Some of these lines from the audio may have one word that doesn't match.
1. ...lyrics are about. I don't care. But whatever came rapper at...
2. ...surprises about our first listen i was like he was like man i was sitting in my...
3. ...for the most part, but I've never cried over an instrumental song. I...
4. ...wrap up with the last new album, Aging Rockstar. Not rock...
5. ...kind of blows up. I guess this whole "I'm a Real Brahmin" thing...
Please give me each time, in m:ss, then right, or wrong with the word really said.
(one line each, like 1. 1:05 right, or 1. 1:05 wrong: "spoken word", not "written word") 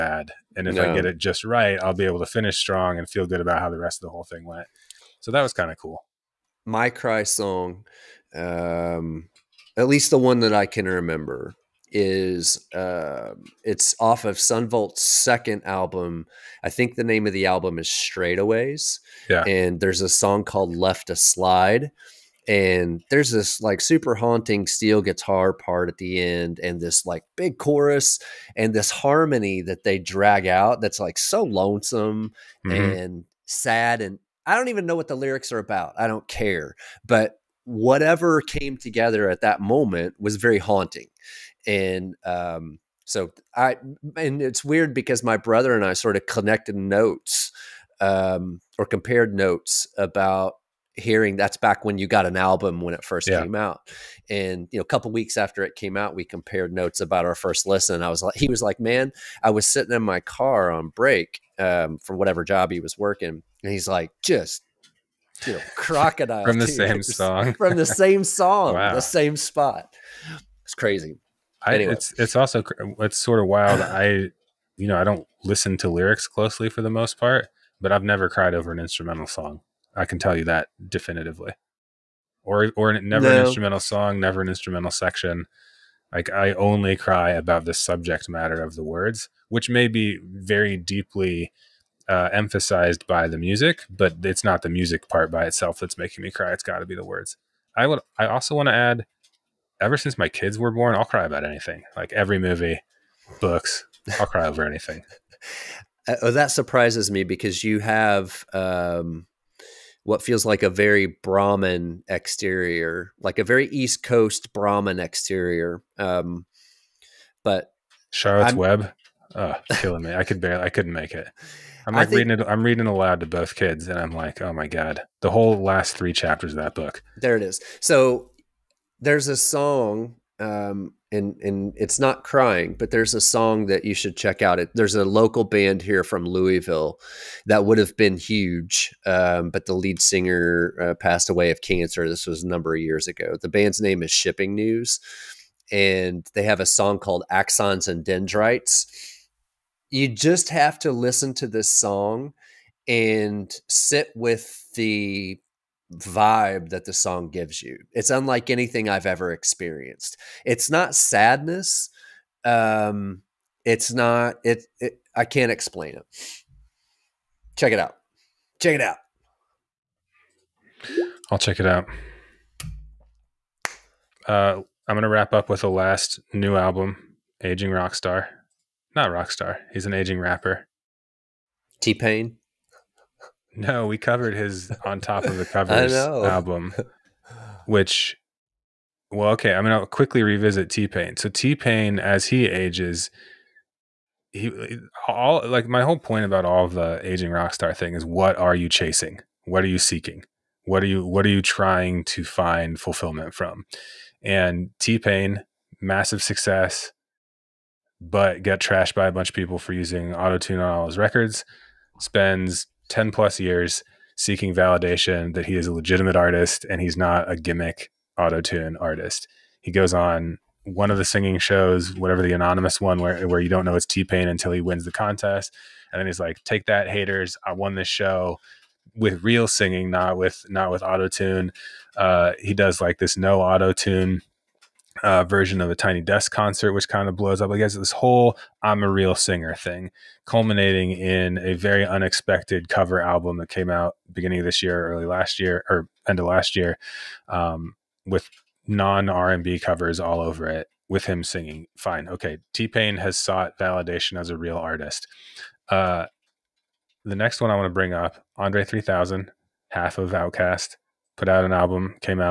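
1. 0:35 wrong: "together", not "rapper"
2. 0:56 wrong: "notes", not "surprises"
3. 1:16 right
4. 2:55 right
5. 3:56 wrong: "Singer", not "Brahmin".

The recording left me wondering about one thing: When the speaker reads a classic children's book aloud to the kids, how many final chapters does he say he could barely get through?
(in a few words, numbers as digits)
3.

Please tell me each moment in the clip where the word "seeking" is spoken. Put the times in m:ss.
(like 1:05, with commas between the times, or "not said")
3:19, 3:34.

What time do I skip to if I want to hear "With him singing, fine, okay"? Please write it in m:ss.
4:10.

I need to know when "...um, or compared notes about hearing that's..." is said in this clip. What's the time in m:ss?
0:48.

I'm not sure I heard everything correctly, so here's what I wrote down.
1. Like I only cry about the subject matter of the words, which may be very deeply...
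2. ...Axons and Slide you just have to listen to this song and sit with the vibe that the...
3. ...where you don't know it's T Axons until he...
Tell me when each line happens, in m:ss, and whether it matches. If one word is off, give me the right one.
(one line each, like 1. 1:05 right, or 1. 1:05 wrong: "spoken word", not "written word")
1. 1:26 right
2. 2:27 wrong: "Dendrites", not "Slide"
3. 3:43 wrong: "Pain", not "Axons".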